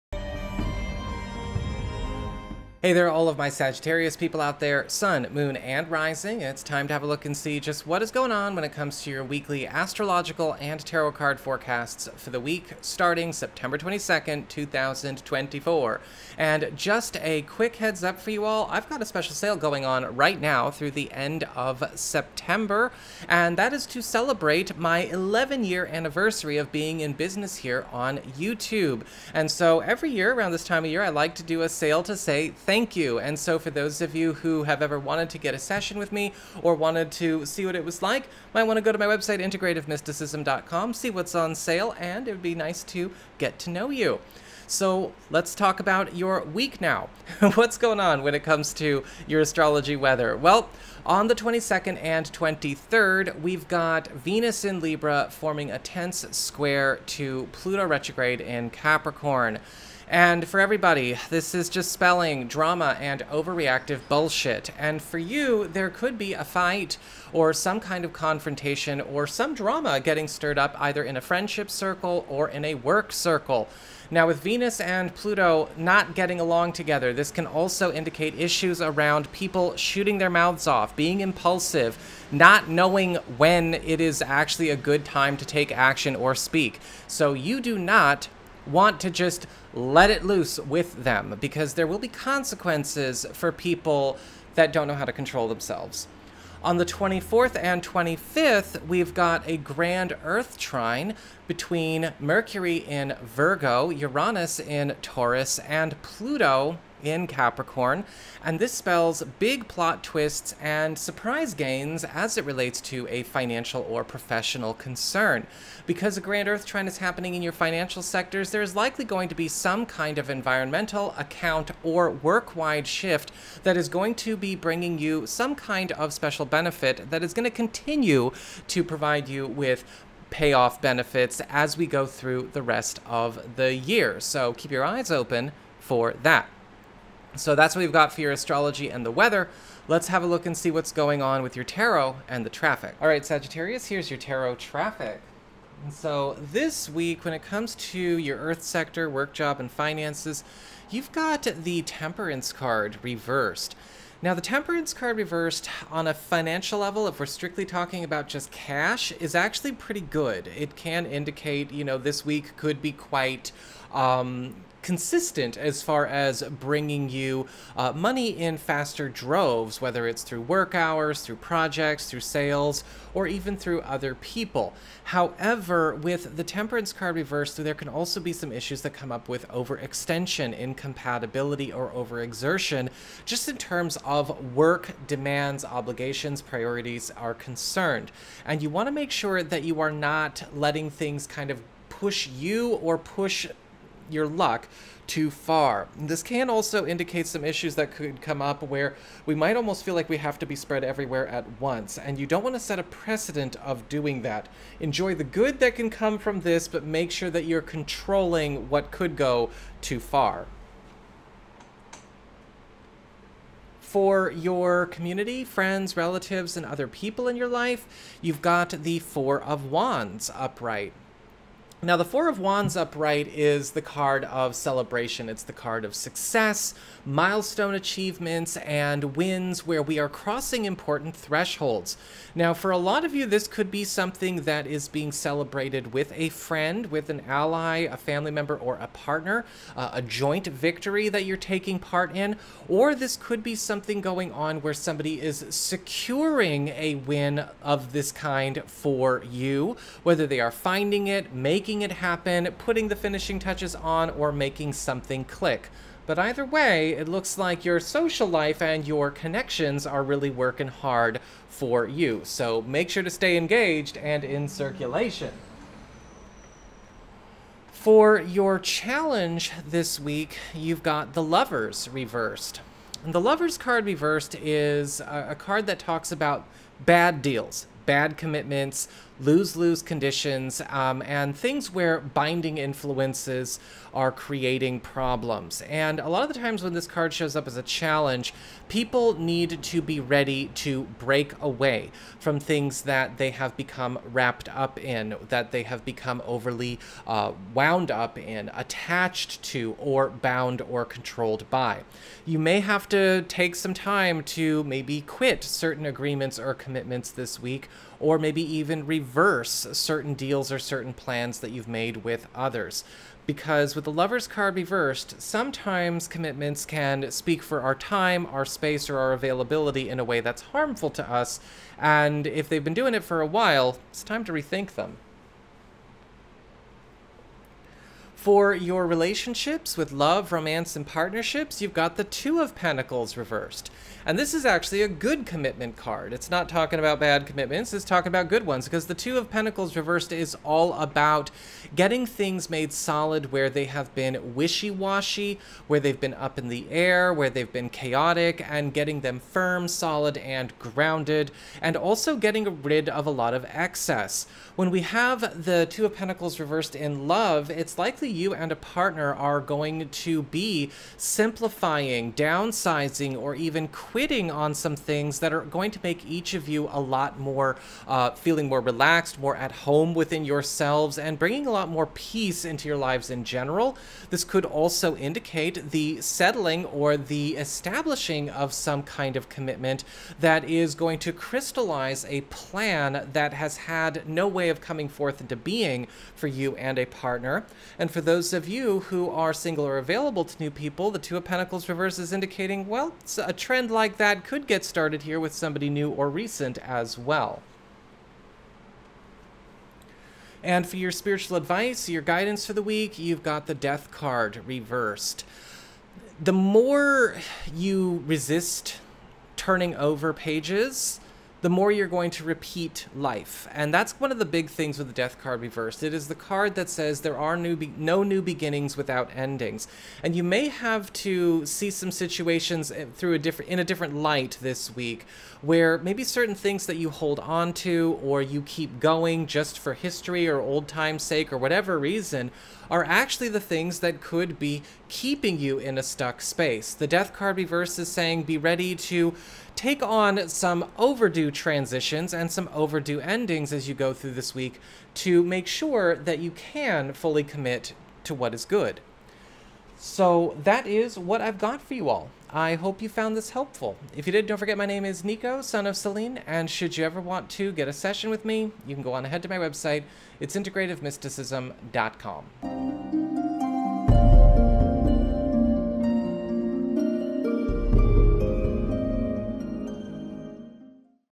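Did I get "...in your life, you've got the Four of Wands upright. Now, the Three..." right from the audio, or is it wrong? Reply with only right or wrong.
wrong.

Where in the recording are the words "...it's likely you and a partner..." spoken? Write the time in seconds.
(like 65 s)
357 s.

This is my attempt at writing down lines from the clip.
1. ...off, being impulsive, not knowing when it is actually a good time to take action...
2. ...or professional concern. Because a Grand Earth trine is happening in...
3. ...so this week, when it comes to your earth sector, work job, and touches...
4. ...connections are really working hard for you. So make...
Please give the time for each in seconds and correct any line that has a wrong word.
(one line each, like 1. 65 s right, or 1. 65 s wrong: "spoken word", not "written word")
1. 80 s right
2. 113 s right
3. 145 s wrong: "finances", not "touches"
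4. 259 s right.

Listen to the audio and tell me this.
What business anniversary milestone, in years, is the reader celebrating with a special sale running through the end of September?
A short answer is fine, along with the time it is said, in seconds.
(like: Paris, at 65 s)
11 years, at 25 s.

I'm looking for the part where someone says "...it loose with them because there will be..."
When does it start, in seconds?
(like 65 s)
90 s.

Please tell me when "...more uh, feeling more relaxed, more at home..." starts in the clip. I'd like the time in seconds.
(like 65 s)
367 s.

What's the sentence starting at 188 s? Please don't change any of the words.
And you want to make sure that you are not letting things kind of push you or push your luck too far.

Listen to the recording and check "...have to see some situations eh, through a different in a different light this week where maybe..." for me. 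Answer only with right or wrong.
right.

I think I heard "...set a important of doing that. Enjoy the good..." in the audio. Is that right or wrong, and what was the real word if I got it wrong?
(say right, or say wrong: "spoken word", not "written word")
wrong: "precedent", not "important".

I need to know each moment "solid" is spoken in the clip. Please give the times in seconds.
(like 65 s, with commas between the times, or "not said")
342 s, 349 s.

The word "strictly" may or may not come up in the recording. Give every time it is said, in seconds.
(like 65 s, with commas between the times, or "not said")
157 s.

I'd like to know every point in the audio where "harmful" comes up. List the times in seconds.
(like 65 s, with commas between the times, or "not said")
320 s.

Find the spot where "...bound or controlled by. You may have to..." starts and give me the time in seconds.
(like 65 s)
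300 s.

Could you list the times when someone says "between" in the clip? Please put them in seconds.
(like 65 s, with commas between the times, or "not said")
101 s.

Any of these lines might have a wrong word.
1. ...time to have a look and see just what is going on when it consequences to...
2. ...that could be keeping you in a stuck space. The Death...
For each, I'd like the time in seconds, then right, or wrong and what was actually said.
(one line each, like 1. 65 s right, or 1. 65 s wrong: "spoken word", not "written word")
1. 6 s wrong: "comes", not "consequences"
2. 433 s right.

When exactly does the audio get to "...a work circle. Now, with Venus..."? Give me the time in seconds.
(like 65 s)
72 s.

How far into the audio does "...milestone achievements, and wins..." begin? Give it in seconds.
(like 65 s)
227 s.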